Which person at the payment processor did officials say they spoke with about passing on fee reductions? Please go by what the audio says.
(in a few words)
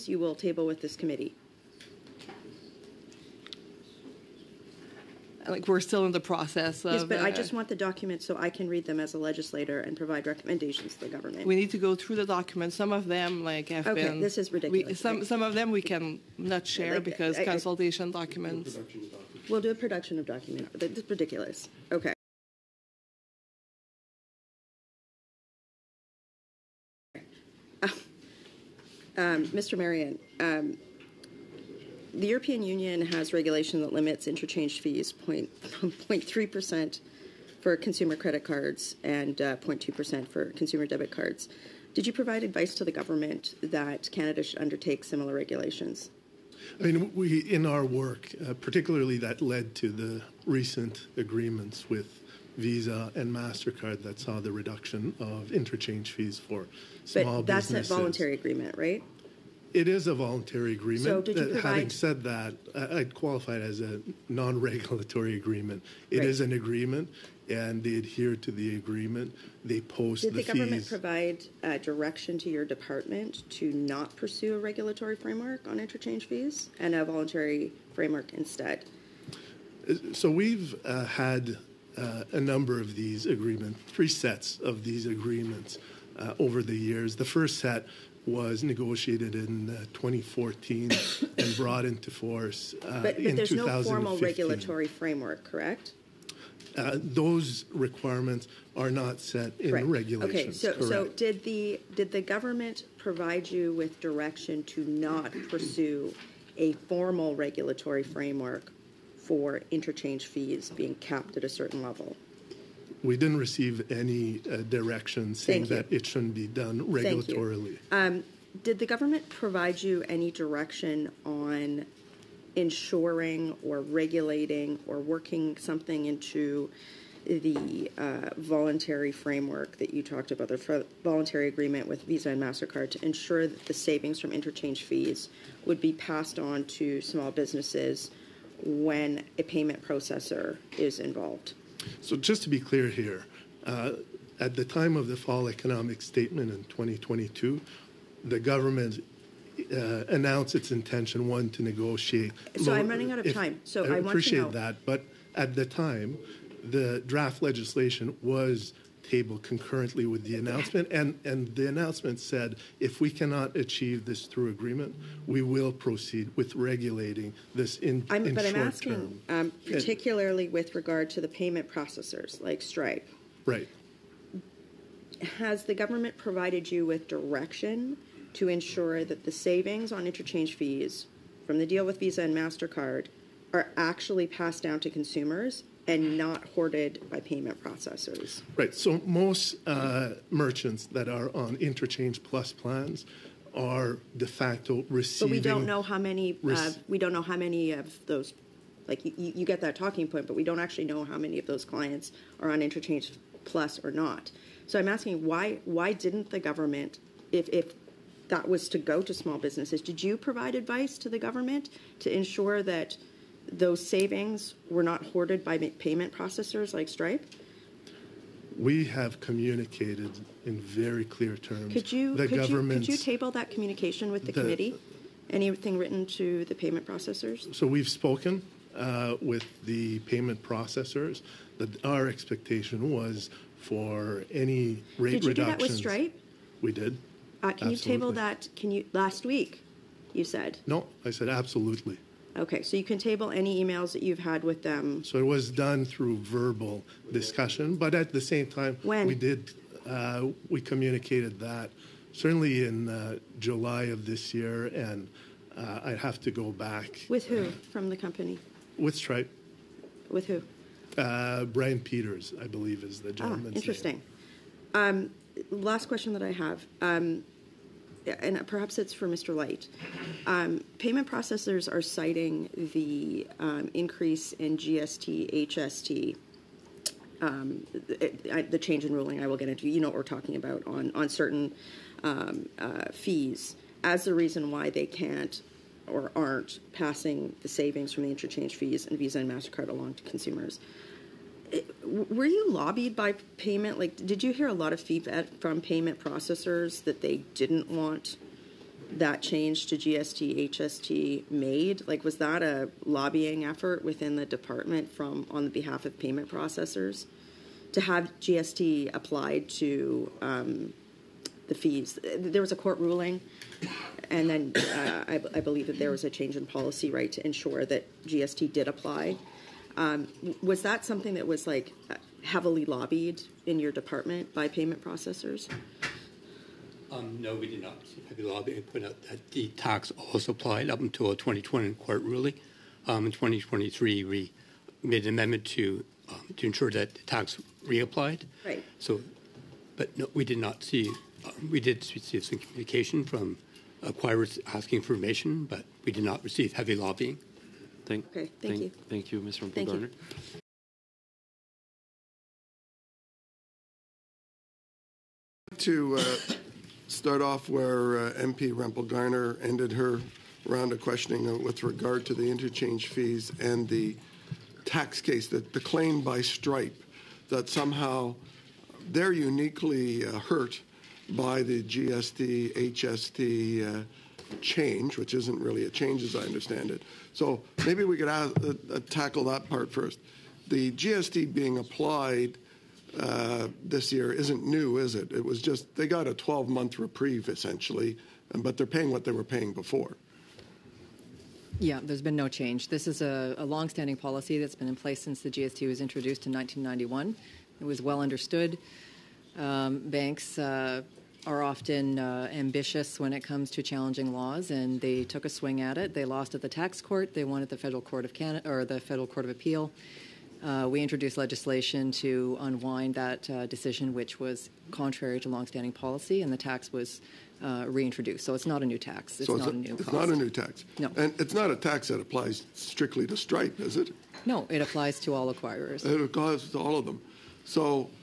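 Brian Peters.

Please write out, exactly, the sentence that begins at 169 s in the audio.
Um, particularly and, with regard to the payment processors like Stripe.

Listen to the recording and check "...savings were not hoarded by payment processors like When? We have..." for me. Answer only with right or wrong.
wrong.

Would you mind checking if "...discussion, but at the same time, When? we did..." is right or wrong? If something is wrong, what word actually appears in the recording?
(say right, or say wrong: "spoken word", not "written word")
right.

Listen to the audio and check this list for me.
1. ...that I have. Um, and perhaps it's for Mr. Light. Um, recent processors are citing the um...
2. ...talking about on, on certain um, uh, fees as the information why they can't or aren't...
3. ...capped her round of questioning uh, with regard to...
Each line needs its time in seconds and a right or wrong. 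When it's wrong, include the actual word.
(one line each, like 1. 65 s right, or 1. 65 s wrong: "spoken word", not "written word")
1. 266 s wrong: "payment", not "recent"
2. 280 s wrong: "reason", not "information"
3. 359 s wrong: "ended", not "capped".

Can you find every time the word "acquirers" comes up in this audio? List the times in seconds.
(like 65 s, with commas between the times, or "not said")
343 s, 425 s.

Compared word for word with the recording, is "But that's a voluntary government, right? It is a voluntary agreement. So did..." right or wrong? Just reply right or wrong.
wrong.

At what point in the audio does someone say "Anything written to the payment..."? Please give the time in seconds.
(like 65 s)
225 s.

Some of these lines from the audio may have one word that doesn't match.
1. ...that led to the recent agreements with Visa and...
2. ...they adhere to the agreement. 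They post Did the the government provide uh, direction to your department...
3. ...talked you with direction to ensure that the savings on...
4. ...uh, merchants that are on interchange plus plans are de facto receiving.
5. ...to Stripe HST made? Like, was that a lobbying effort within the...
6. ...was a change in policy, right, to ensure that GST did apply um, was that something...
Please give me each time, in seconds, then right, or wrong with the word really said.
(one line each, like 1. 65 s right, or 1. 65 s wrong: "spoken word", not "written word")
1. 49 s right
2. 67 s right
3. 176 s wrong: "provided", not "talked"
4. 189 s right
5. 299 s wrong: "GST", not "Stripe"
6. 315 s right.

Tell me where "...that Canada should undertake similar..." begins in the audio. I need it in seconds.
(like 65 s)
43 s.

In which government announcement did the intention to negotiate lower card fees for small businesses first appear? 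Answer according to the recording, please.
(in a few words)
fall economic statement.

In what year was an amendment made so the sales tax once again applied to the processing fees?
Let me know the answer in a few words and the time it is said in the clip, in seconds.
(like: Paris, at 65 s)
2023, at 333 s.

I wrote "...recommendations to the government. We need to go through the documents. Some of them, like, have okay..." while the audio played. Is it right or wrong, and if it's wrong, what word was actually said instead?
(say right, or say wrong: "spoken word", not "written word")
right.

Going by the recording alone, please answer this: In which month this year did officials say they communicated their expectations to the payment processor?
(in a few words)
July.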